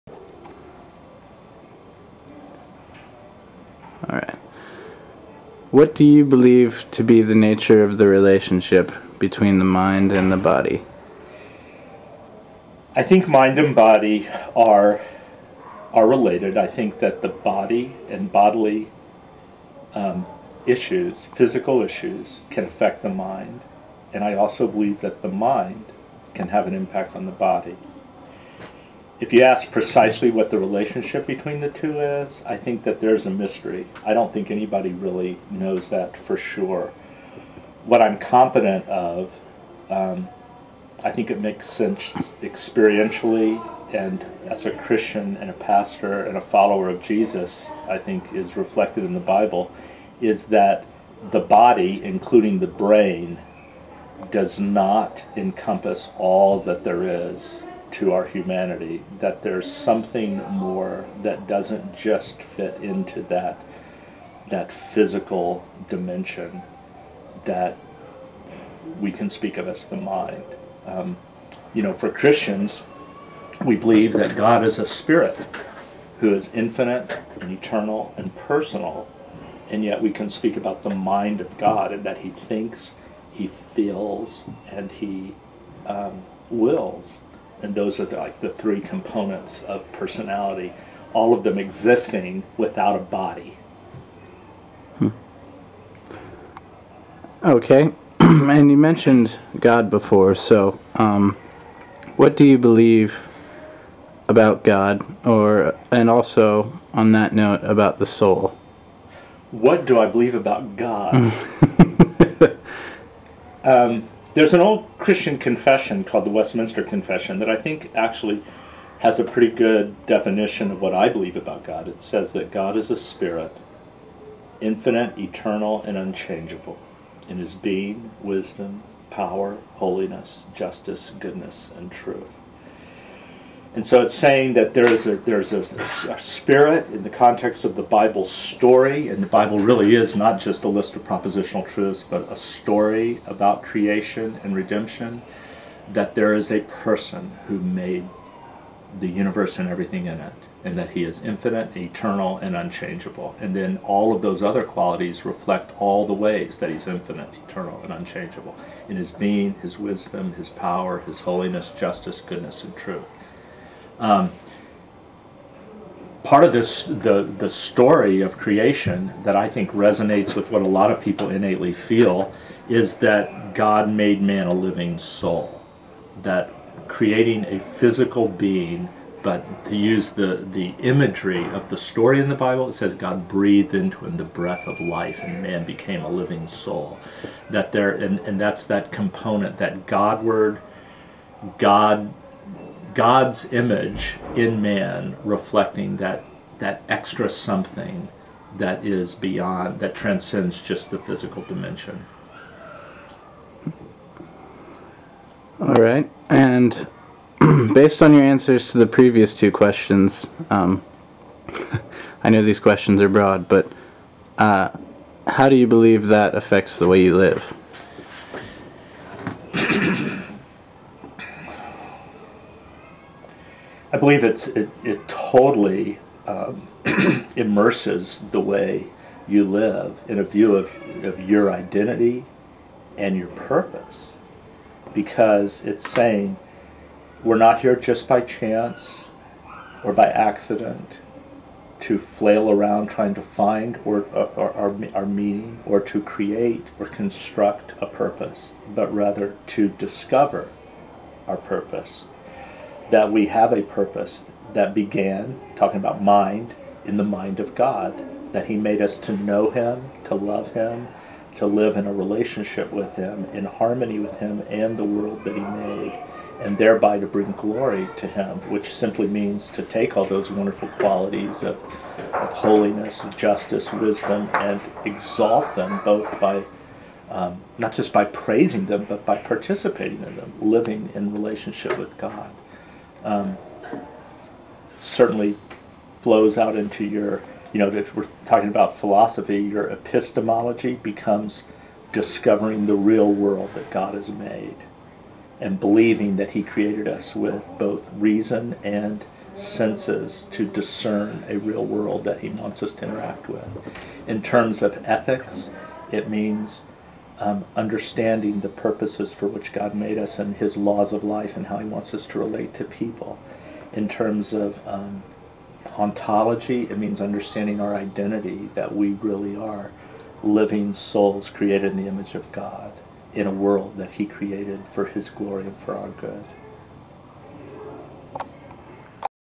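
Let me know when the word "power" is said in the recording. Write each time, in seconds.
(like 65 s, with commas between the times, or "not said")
129 s, 160 s.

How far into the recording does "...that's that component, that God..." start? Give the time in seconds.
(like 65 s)
188 s.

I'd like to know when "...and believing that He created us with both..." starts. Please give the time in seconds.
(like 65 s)
295 s.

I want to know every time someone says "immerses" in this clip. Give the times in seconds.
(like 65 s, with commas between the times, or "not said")
227 s.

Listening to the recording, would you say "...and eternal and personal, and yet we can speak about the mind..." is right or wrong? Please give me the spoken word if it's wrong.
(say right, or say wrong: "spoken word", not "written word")
right.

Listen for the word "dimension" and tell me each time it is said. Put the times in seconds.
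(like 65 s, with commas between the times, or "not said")
65 s, 201 s.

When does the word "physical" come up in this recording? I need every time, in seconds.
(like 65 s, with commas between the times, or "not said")
21 s, 64 s, 177 s, 200 s.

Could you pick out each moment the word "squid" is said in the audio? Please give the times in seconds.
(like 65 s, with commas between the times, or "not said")
not said.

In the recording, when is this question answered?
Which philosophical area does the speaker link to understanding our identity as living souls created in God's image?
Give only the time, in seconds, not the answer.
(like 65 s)
315 s.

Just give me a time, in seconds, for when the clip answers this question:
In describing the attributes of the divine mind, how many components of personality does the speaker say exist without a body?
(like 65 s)
88 s.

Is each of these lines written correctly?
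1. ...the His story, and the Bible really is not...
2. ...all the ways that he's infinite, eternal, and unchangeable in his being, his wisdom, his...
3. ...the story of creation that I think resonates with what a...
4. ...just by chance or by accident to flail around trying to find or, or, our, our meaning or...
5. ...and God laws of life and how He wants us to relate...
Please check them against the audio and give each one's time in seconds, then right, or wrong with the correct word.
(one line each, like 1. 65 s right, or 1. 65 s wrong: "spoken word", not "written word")
1. 137 s wrong: "Bible", not "His"
2. 155 s right
3. 167 s right
4. 237 s right
5. 310 s wrong: "His", not "God".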